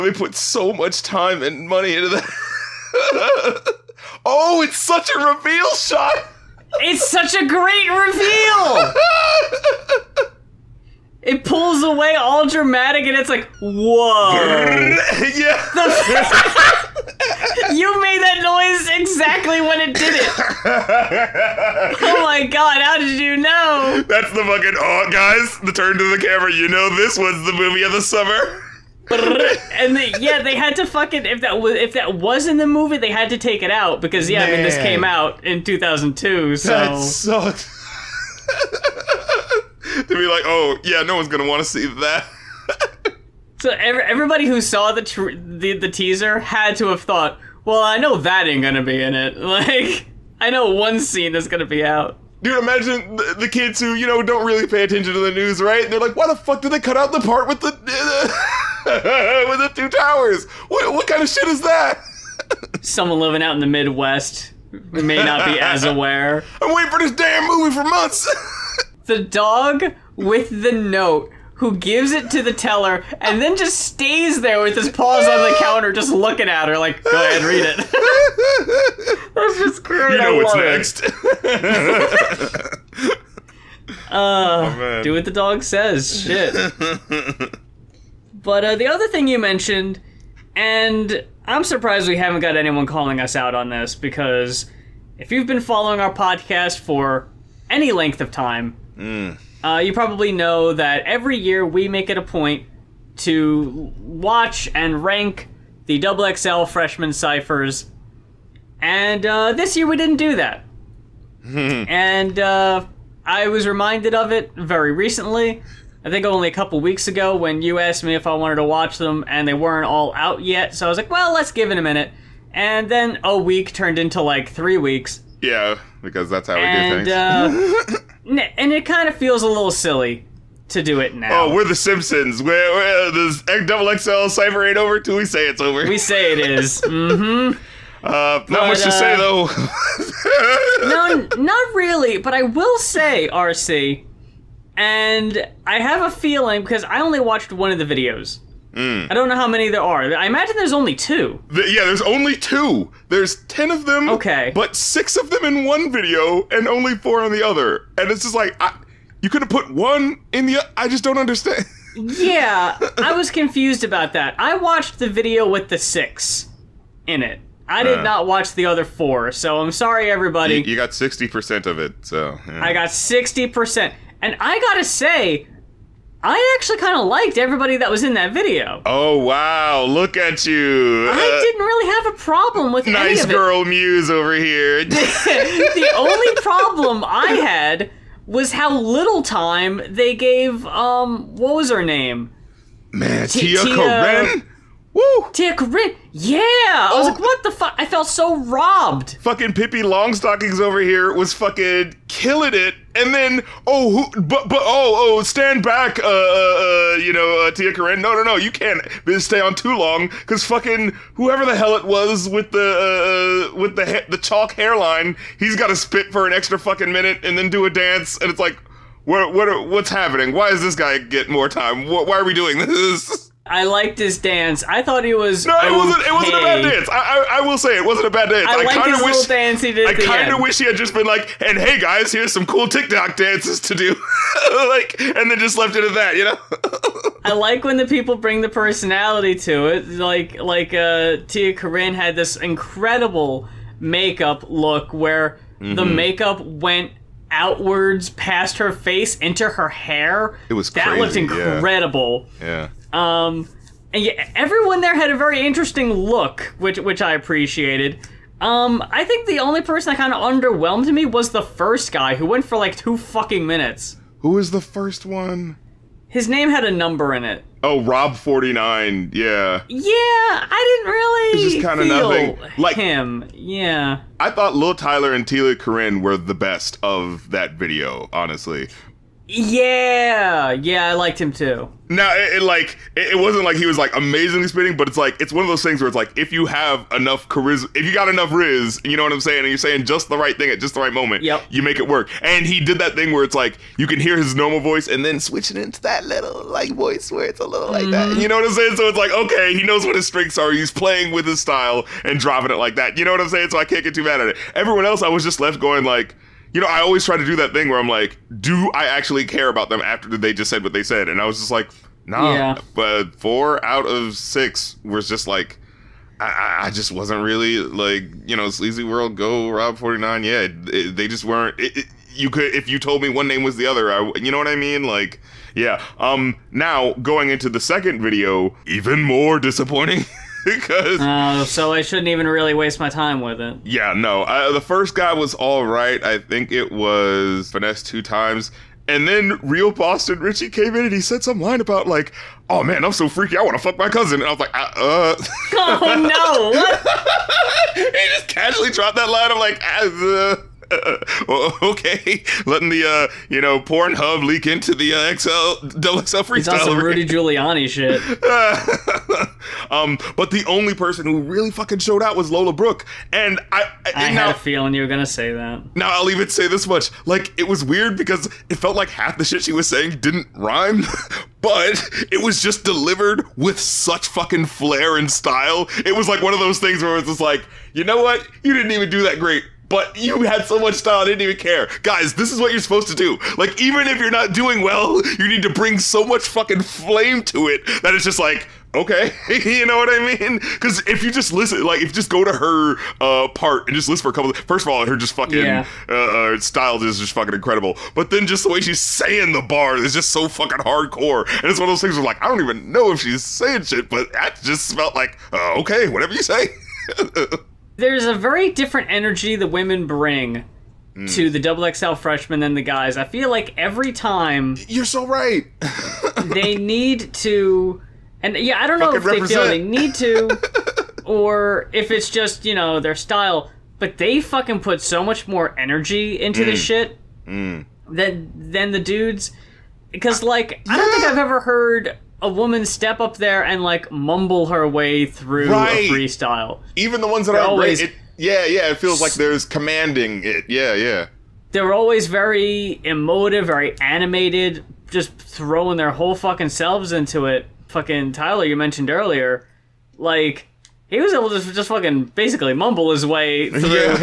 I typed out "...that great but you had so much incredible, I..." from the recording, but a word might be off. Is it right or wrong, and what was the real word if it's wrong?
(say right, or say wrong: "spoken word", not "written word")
wrong: "style", not "incredible".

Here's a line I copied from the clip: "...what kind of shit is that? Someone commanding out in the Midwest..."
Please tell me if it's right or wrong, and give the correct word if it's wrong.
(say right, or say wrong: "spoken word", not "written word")
wrong: "living", not "commanding".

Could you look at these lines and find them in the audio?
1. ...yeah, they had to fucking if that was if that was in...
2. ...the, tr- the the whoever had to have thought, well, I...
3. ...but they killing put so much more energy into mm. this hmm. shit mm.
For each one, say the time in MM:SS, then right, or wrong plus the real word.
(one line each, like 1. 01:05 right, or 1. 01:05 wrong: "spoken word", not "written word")
1. 00:30 right
2. 00:44 wrong: "teaser", not "whoever"
3. 07:03 wrong: "fucking", not "killing".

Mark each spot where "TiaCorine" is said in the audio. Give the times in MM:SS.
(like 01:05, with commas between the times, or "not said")
03:27, 04:01, 04:35.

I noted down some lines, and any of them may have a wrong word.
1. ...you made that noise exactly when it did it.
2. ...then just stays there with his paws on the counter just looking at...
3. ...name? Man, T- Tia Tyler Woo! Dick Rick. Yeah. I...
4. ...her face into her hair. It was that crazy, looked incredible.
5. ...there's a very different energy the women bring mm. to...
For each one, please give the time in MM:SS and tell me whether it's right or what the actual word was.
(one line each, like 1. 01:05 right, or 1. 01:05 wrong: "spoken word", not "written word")
1. 00:14 right
2. 01:13 right
3. 03:11 wrong: "Tia", not "Tyler"
4. 04:08 right
5. 06:47 right.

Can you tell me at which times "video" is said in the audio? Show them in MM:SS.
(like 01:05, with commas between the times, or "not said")
02:27, 02:35, 02:45, 02:58, 04:37, 05:28.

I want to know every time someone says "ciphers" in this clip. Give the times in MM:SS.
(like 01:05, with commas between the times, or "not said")
01:47, 02:14.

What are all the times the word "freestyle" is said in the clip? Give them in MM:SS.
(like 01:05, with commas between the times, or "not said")
05:56, 07:15.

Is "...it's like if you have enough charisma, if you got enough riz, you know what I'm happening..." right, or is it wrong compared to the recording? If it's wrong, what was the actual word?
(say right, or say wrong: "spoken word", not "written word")
wrong: "saying", not "happening".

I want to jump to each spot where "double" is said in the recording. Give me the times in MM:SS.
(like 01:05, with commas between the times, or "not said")
02:13, 05:55, 06:51.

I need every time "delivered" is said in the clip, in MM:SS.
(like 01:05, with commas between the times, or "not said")
06:12.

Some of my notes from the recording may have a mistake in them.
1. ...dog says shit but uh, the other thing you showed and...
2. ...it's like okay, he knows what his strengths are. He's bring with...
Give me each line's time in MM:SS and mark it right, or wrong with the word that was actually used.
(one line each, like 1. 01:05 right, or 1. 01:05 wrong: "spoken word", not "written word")
1. 01:25 wrong: "mentioned", not "showed"
2. 04:58 wrong: "playing", not "bring".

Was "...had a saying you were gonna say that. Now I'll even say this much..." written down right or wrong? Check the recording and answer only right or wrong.
wrong.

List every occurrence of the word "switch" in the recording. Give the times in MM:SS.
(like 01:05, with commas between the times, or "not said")
04:55.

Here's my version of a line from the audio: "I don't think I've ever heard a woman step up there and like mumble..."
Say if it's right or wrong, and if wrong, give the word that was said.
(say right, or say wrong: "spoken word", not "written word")
right.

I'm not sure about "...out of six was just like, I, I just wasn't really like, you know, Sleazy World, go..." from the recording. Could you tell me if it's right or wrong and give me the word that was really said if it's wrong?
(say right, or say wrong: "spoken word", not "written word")
right.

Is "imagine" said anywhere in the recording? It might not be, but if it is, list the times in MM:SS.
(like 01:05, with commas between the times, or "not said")
00:52, 02:30.